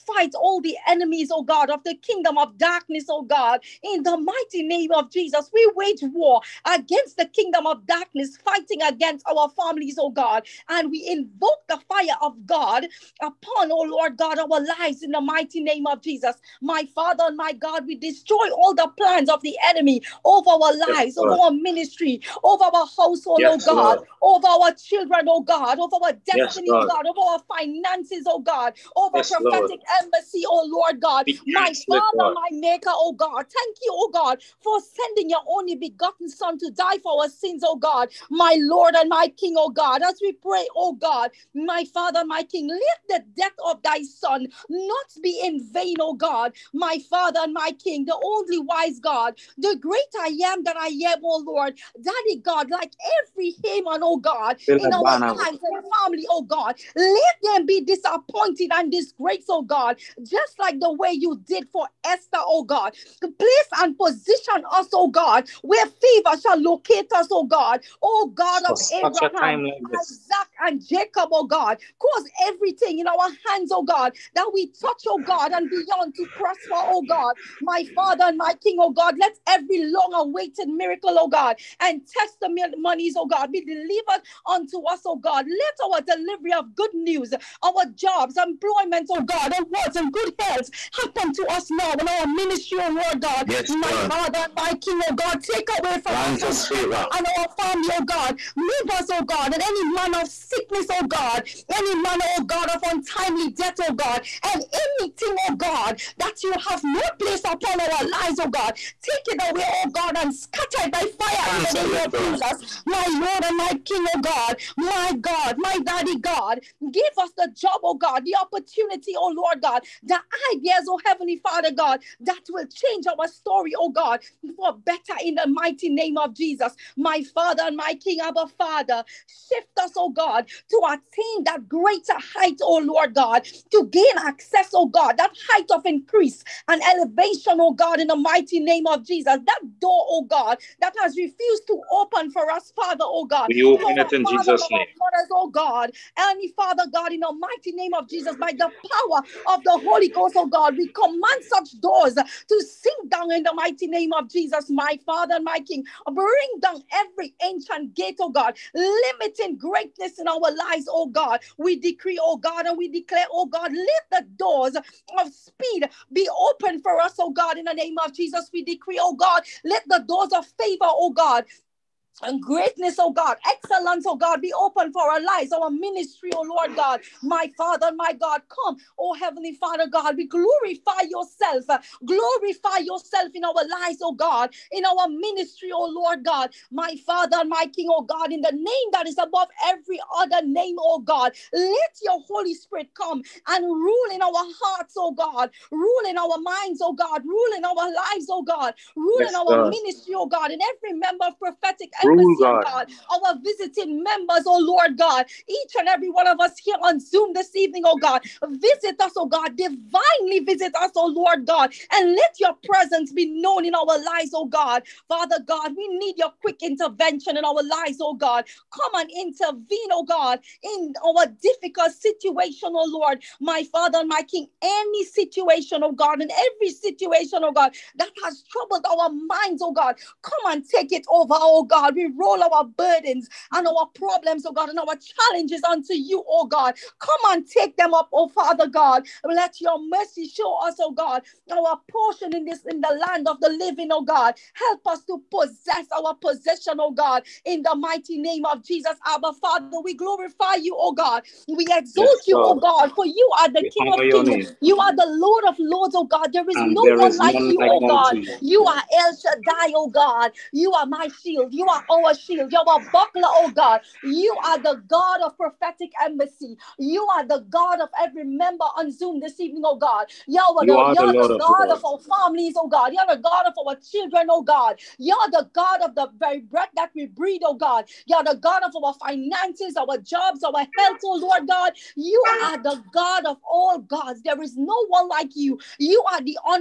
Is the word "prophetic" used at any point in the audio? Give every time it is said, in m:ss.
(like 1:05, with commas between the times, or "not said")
0:29, 3:21, 4:25.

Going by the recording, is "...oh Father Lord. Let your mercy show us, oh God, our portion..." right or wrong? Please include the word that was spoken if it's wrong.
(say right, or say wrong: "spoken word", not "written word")
wrong: "God", not "Lord".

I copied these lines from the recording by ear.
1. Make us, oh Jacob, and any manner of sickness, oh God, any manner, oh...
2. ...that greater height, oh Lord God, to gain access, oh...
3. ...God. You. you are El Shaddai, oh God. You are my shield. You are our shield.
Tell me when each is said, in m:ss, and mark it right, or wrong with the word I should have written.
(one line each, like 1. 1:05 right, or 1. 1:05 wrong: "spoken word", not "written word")
1. 1:38 wrong: "God", not "Jacob"
2. 2:11 right
3. 4:17 right.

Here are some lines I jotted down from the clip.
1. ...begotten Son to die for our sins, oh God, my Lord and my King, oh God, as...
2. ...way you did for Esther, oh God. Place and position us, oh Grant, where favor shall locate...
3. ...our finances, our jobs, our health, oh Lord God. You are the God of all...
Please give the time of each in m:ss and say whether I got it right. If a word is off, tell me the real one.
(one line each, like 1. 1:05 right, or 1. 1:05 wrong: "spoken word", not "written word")
1. 0:35 right
2. 1:00 wrong: "God", not "Grant"
3. 4:38 right.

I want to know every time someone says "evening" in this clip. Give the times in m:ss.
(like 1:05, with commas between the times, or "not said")
3:27, 4:29.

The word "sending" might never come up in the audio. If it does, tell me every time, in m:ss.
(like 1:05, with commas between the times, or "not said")
0:34.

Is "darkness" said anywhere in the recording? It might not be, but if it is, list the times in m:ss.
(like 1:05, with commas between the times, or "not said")
0:02, 0:07.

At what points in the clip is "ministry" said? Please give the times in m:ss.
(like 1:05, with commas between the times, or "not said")
0:21, 1:32, 2:55, 3:05, 3:19.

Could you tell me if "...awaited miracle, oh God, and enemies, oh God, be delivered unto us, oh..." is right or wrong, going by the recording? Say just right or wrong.
wrong.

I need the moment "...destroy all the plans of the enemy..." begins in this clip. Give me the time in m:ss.
0:17.